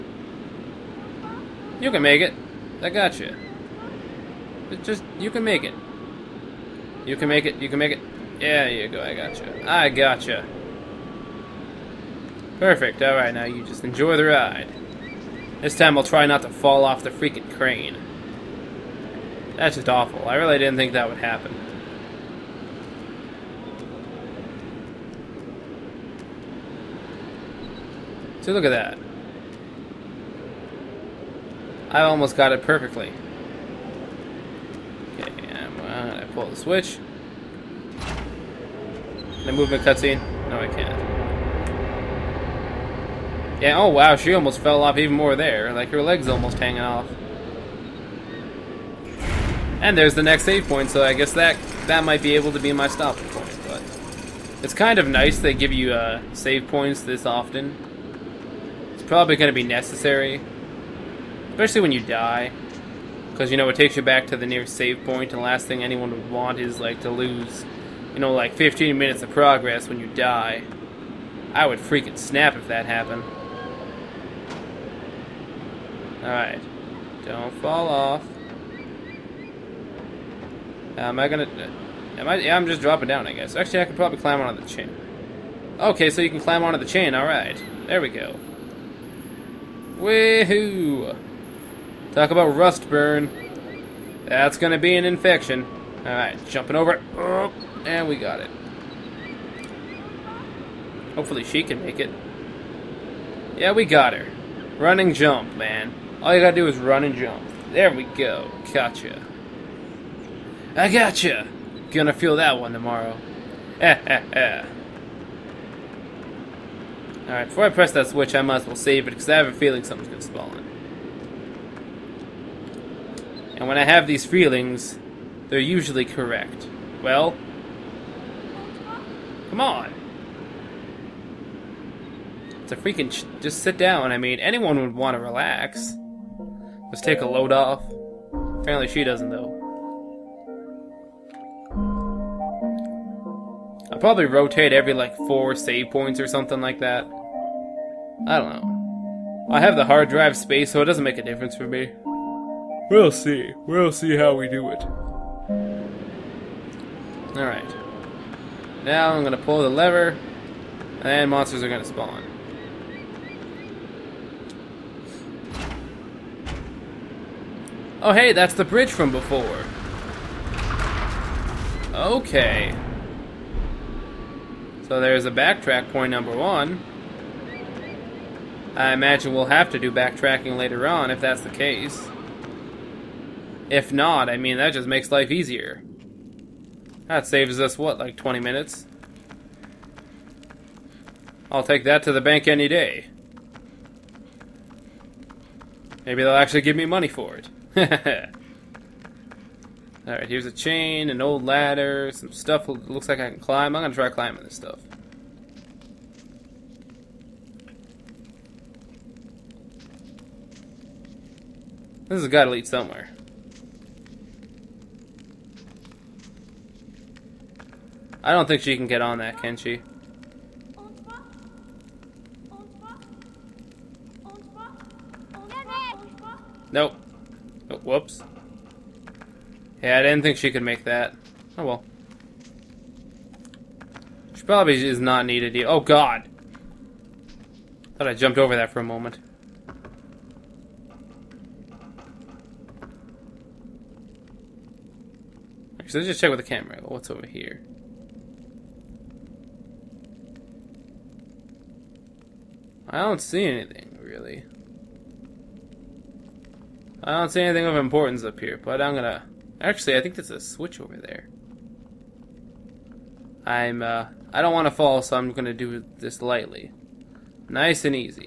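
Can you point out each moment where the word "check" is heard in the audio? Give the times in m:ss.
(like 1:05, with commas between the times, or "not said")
4:06.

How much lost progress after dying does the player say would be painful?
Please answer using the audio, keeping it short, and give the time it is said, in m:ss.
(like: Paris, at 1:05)
15 minutes, at 1:08.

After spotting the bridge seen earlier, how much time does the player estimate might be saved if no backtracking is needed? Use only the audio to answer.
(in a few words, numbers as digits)
20 minutes.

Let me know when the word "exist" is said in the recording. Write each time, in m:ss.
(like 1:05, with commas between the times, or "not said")
not said.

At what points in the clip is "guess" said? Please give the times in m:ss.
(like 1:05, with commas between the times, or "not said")
0:51, 1:23.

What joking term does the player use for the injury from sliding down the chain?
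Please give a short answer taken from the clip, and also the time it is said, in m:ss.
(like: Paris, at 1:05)
rust burn, at 1:32.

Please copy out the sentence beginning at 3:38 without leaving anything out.
I don't think she can get on that, can she?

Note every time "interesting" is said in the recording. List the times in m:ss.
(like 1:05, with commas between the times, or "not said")
not said.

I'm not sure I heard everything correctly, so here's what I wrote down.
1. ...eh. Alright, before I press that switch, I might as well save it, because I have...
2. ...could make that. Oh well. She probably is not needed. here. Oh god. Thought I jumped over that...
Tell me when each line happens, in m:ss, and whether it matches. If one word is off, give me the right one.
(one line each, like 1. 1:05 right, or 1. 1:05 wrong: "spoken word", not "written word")
1. 1:54 right
2. 3:50 right.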